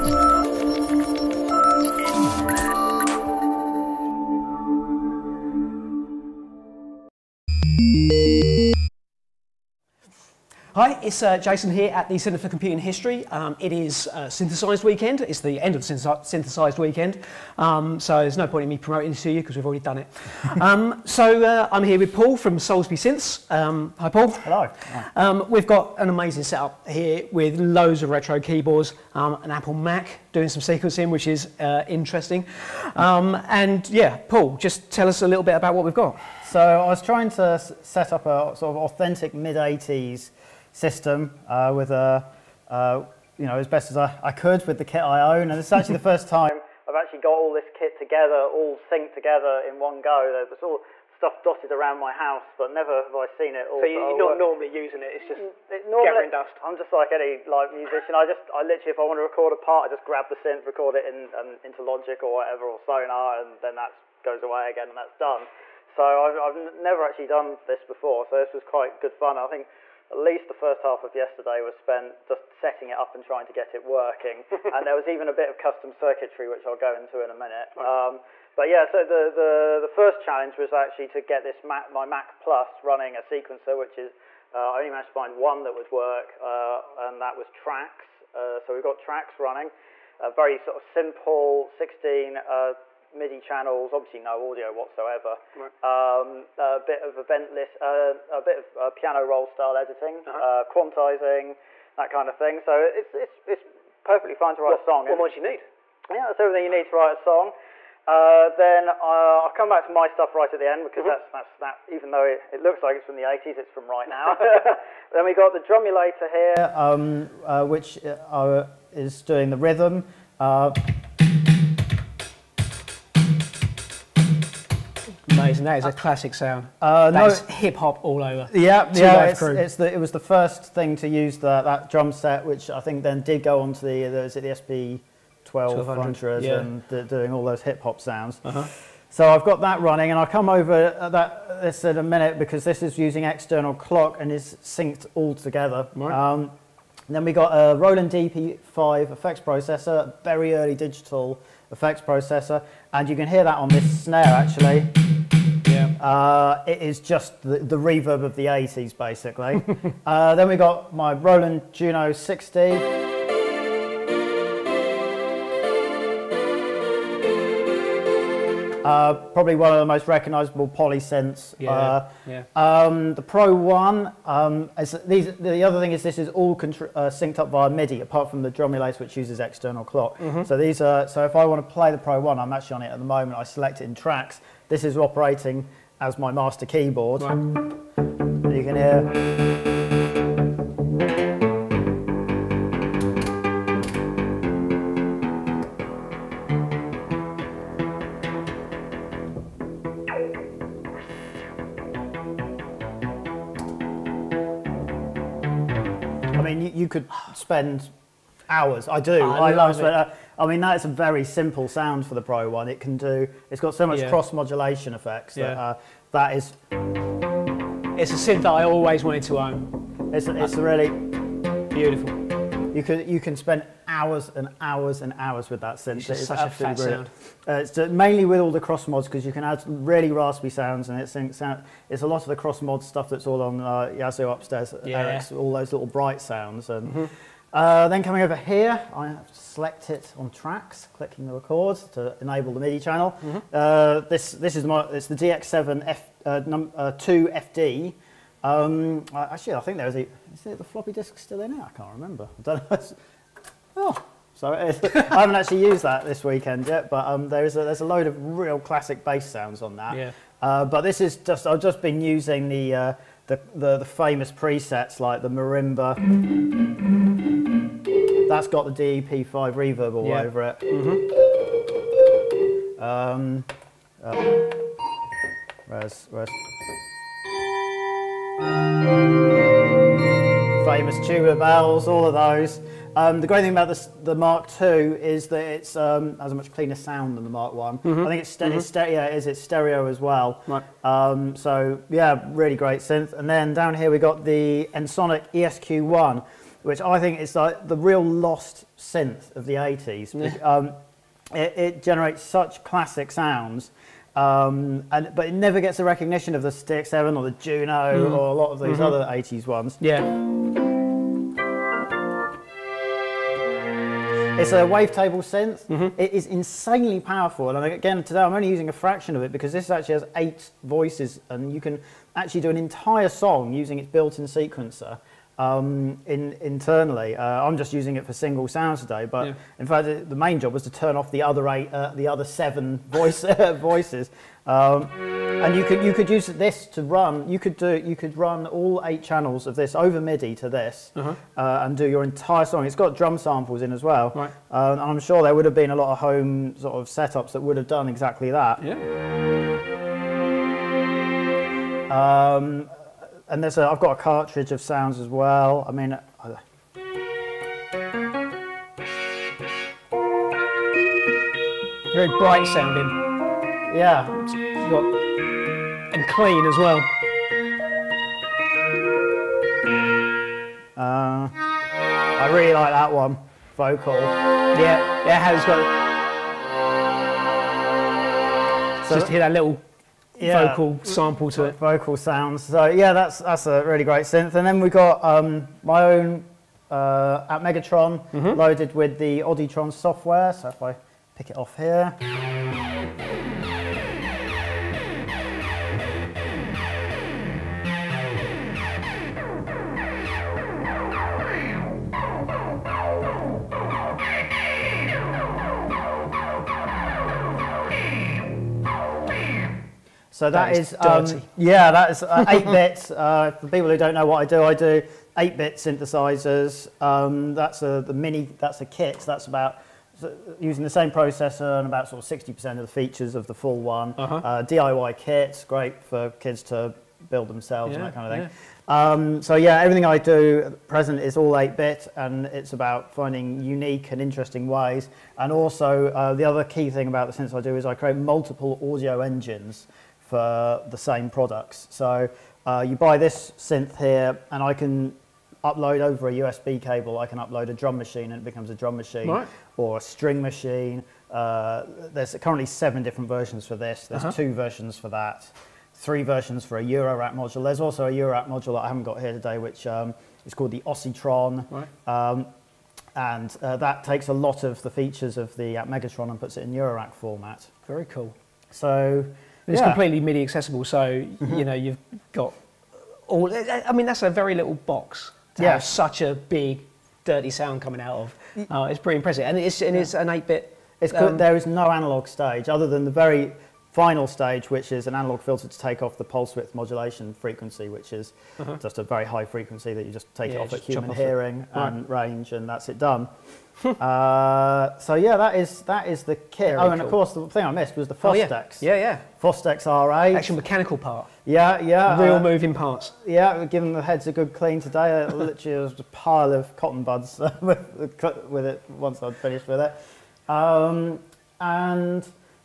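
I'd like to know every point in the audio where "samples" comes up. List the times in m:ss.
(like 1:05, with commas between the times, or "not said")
5:43, 6:20.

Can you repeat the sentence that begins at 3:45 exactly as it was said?
It's, it's such a fat sound.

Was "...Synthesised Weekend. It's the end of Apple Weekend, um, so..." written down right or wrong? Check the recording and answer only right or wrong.
wrong.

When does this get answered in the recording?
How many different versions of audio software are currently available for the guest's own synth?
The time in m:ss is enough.
7:32.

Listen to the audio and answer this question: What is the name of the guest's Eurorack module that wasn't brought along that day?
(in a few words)
Oscitron.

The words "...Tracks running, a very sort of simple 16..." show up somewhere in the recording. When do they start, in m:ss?
1:28.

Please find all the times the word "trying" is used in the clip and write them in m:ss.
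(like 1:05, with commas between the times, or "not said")
0:37, 1:13.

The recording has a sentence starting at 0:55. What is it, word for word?
It's just it, normally, gathering dust.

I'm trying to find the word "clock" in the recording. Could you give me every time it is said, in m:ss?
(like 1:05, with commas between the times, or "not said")
2:23, 2:59.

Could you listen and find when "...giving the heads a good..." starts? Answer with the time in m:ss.
8:23.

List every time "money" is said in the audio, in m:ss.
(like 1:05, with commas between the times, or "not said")
not said.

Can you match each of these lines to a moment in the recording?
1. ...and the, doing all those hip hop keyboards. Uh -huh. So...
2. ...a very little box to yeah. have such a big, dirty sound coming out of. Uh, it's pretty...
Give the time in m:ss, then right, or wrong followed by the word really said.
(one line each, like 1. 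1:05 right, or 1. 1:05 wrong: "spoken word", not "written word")
1. 2:16 wrong: "sounds", not "keyboards"
2. 7:54 right.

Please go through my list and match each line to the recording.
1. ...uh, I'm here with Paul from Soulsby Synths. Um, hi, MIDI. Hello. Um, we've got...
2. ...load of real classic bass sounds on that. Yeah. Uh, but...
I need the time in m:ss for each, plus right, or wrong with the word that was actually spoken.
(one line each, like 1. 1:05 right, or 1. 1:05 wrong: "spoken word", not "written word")
1. 0:21 wrong: "Paul", not "MIDI"
2. 4:17 right.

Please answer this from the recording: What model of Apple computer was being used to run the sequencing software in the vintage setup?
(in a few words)
Mac Plus.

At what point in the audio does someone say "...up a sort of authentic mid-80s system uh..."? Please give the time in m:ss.
0:38.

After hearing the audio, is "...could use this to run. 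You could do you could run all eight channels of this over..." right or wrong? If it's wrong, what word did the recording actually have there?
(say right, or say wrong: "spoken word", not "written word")
right.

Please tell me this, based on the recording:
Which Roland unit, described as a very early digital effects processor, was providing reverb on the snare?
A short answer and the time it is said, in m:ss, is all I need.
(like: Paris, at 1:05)
Roland DEP5, at 2:27.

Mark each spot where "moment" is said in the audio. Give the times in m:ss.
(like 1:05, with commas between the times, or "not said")
3:03.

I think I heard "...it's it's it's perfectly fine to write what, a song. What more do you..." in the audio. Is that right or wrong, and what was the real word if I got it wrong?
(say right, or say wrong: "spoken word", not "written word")
right.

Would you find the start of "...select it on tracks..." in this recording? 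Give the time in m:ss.
3:59.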